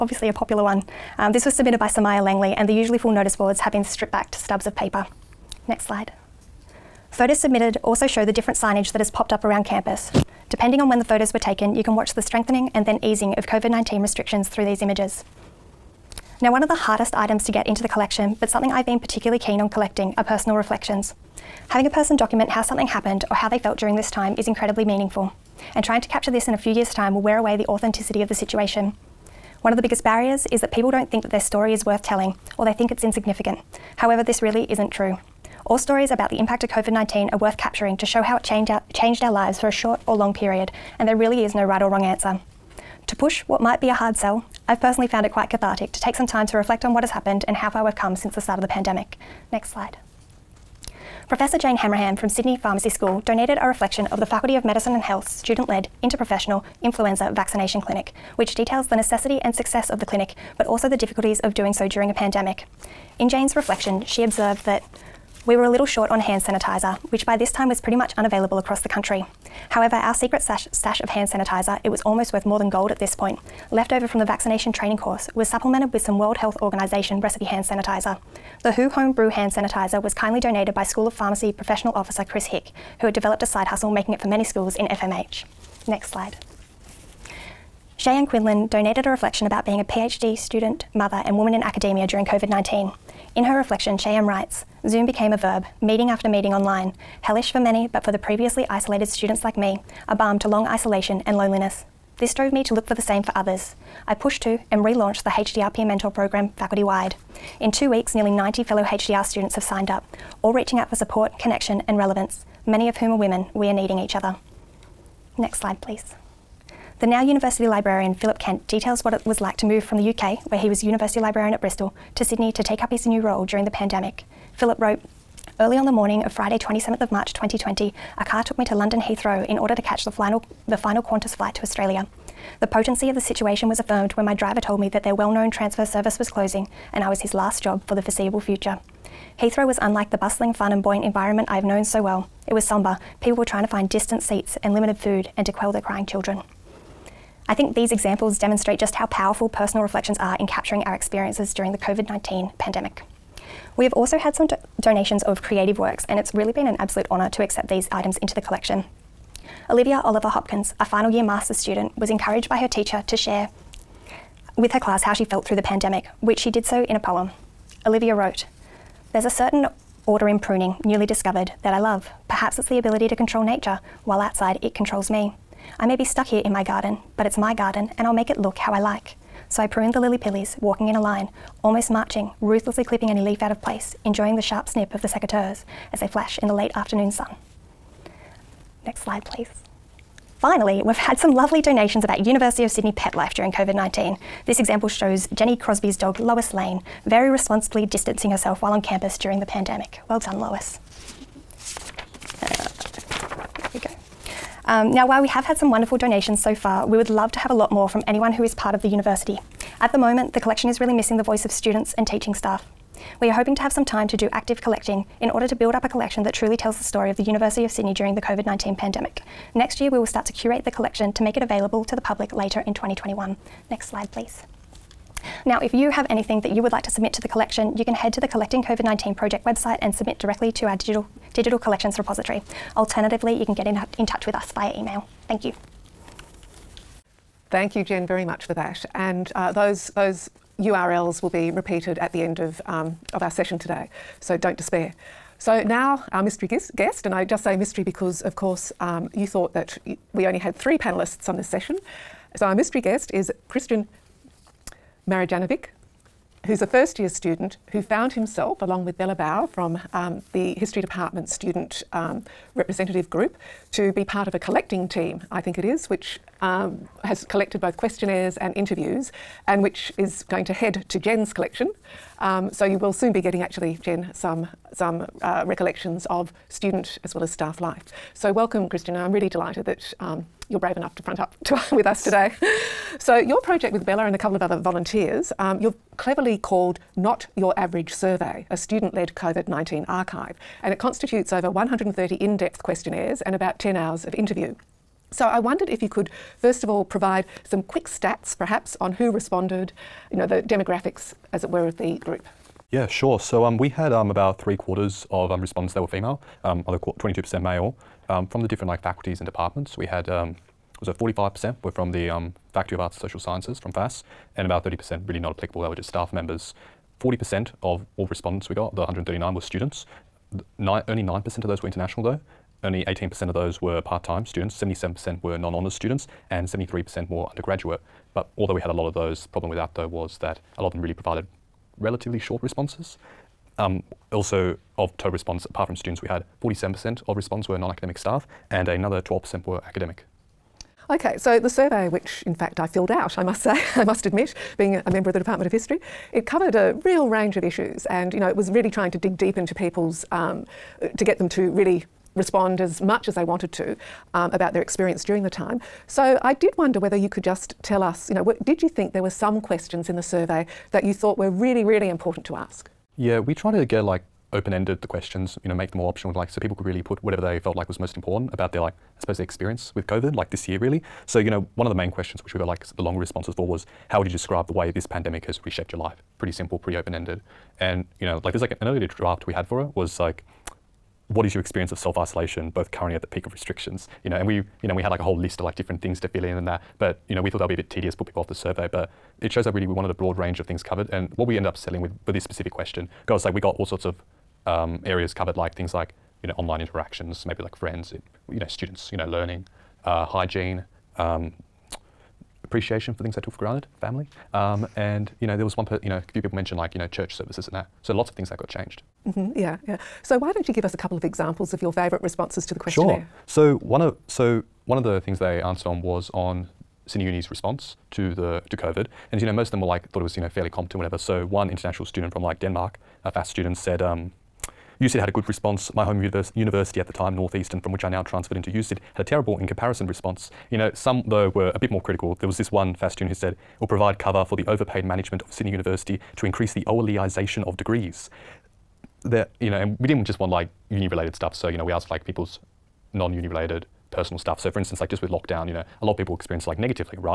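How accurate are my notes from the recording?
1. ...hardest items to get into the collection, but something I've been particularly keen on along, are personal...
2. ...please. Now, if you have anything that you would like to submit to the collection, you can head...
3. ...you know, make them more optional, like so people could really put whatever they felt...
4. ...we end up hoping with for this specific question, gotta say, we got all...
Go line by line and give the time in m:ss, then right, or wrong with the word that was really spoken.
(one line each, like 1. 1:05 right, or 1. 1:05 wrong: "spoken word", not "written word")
1. 0:16 wrong: "collecting", not "along"
2. 3:44 right
3. 6:05 right
4. 6:31 wrong: "settling", not "hoping".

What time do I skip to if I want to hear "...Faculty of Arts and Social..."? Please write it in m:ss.
5:12.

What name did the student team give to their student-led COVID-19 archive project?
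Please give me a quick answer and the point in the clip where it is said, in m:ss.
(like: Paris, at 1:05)
Not Your Average Survey, at 4:46.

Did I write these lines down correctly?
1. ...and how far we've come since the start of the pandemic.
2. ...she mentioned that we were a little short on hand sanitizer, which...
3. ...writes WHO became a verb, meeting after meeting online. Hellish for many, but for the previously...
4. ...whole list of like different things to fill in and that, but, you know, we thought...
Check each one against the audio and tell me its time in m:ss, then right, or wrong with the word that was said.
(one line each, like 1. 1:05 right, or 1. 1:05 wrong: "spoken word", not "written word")
1. 0:47 right
2. 1:04 wrong: "observed", not "mentioned"
3. 1:34 wrong: "Zoom", not "WHO"
4. 6:25 right.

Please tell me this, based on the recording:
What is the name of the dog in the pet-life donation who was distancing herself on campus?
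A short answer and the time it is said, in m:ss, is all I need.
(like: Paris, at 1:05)
Lois Lane, at 3:16.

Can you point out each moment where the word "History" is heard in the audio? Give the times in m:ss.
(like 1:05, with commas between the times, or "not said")
4:20, 5:45.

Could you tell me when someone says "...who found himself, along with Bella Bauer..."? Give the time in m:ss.
4:17.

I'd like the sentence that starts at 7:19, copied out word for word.
That you know, and we didn't just want like uni-related stuff.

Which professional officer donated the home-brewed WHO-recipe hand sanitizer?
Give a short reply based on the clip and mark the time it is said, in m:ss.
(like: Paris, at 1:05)
Chris Hick, at 1:22.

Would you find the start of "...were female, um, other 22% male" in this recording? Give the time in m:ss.
5:05.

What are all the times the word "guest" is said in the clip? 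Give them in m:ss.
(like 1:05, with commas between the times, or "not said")
4:06, 4:12.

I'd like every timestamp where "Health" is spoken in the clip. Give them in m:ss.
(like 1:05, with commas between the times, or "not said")
0:54, 1:16.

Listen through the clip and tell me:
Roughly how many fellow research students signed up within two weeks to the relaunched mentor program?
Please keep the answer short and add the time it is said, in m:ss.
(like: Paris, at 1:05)
90, at 1:48.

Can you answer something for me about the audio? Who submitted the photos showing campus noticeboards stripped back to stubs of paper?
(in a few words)
Somaya Langley.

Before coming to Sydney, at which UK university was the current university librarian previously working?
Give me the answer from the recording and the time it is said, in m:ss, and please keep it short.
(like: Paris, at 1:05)
Bristol, at 2:01.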